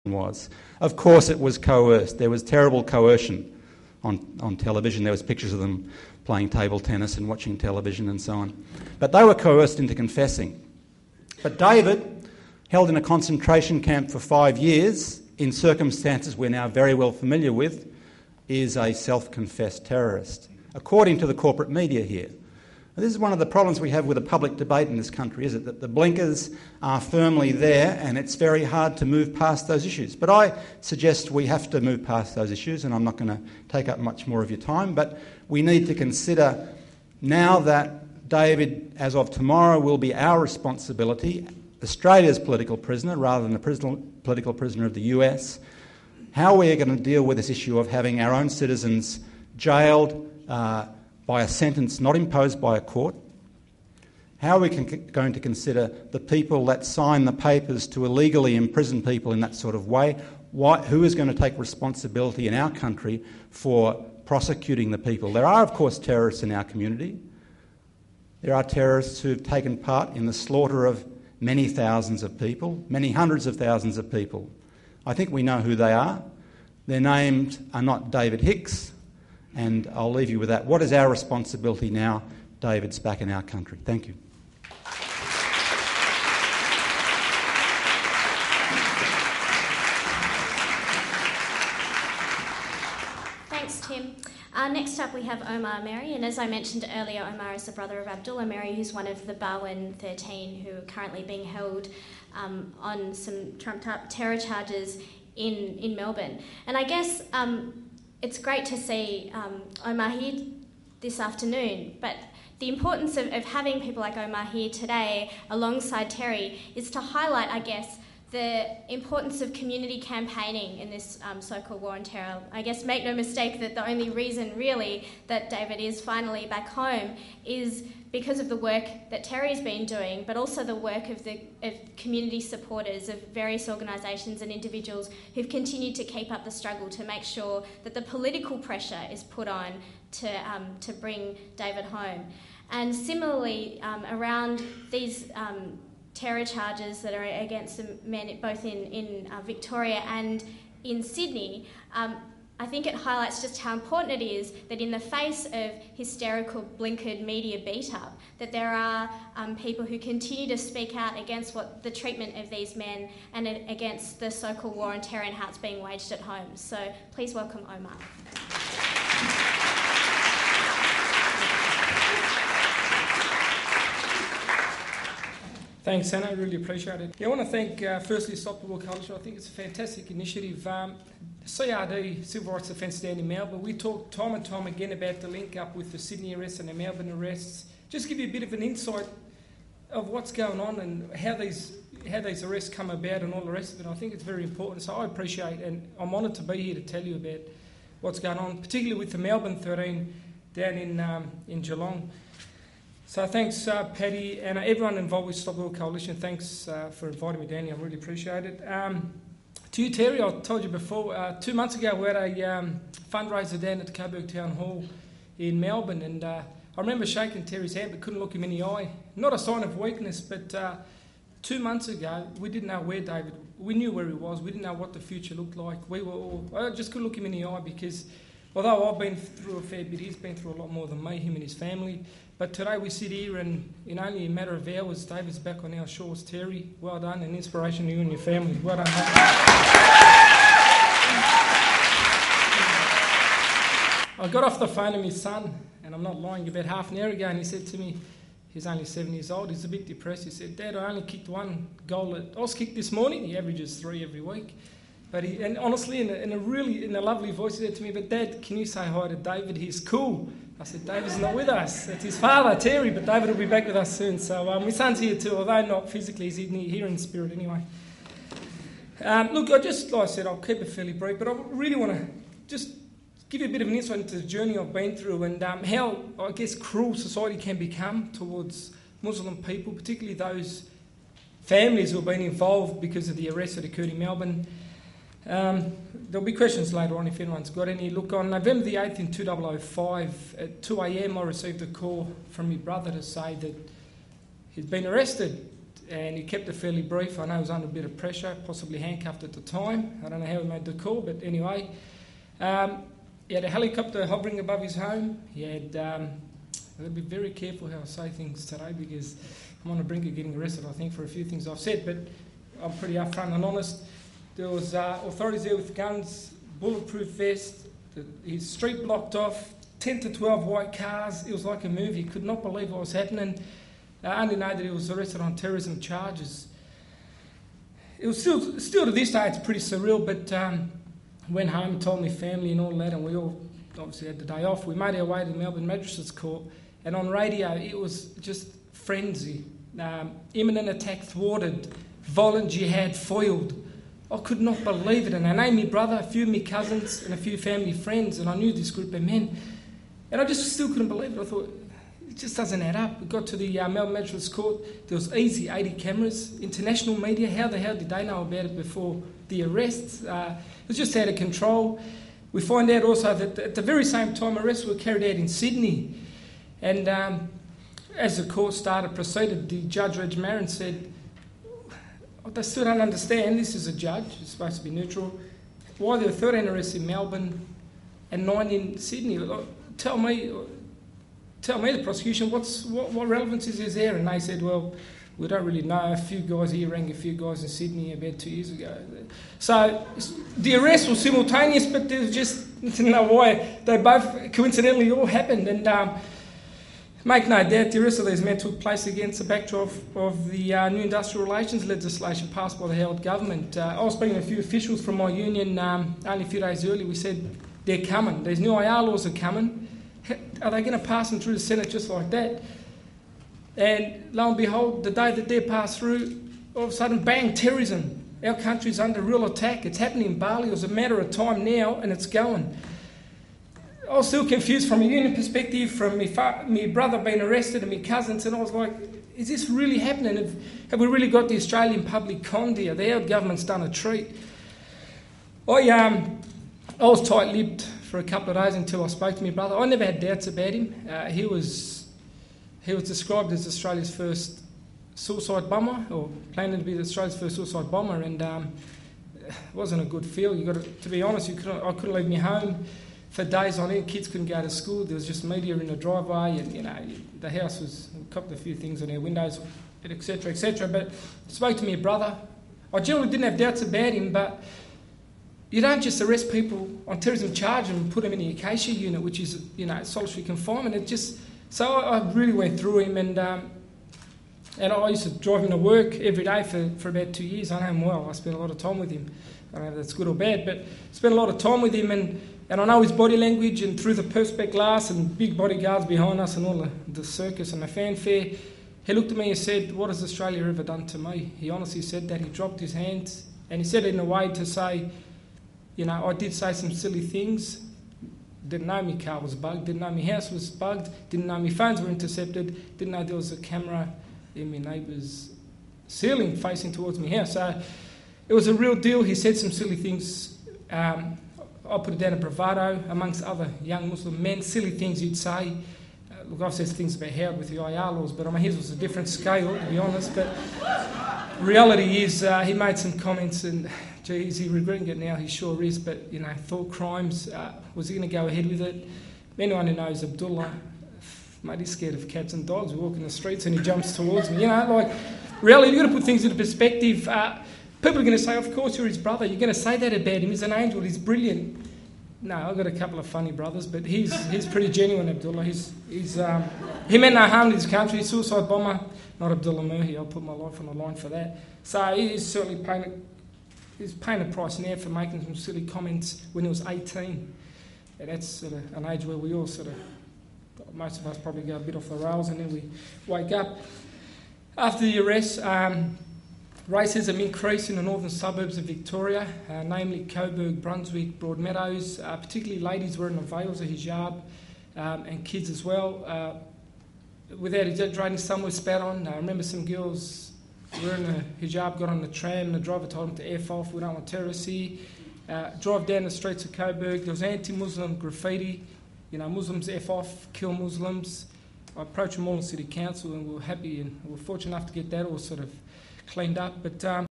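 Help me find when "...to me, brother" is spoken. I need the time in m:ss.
7:41.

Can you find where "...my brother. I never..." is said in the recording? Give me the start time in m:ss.
7:19.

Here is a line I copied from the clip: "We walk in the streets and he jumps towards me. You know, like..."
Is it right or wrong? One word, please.
right.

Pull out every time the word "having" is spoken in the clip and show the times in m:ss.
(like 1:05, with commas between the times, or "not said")
0:47, 1:53.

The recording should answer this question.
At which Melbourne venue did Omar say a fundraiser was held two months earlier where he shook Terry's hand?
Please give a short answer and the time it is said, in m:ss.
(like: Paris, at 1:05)
Coburg Town Hall, at 3:33.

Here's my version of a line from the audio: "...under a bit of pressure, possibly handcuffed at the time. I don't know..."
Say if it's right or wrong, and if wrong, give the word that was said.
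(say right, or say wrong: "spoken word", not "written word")
right.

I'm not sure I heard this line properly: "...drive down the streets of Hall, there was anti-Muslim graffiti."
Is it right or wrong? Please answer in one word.
wrong.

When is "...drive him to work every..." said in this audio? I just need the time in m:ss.
7:55.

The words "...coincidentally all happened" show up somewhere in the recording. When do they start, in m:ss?
6:34.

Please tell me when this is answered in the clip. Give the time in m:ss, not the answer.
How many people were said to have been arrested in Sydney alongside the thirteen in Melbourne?
6:18.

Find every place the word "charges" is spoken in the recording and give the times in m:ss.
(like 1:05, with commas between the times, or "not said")
1:44, 2:26, 5:25, 7:47.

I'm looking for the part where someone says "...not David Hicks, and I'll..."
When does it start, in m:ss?
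1:17.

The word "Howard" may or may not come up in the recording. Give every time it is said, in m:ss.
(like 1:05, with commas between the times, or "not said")
6:42, 8:37.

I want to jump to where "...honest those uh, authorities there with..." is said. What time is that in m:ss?
5:13.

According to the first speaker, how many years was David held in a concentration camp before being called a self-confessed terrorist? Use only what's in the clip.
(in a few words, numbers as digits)
5.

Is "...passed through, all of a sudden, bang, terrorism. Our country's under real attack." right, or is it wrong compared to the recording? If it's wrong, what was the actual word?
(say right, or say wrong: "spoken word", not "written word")
right.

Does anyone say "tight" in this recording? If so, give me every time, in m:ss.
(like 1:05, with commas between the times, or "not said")
7:17.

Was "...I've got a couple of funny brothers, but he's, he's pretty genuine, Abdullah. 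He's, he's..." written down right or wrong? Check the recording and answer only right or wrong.
right.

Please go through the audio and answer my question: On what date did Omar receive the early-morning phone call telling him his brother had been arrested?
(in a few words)
November 8, 2005.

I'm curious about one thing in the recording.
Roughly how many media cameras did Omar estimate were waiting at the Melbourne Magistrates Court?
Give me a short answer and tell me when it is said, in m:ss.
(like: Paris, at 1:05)
80, at 5:55.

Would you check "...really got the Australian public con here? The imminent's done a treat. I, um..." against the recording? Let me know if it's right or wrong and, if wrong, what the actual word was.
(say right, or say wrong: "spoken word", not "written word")
wrong: "government", not "imminent".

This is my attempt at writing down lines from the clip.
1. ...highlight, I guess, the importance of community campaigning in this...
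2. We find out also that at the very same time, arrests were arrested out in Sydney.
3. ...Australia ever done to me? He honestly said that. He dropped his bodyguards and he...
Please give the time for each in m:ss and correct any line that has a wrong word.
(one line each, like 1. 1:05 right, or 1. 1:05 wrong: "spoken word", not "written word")
1. 1:57 right
2. 6:02 wrong: "carried", not "arrested"
3. 8:10 wrong: "hands", not "bodyguards".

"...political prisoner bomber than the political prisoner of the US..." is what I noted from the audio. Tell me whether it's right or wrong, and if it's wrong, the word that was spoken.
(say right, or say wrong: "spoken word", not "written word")
wrong: "rather", not "bomber".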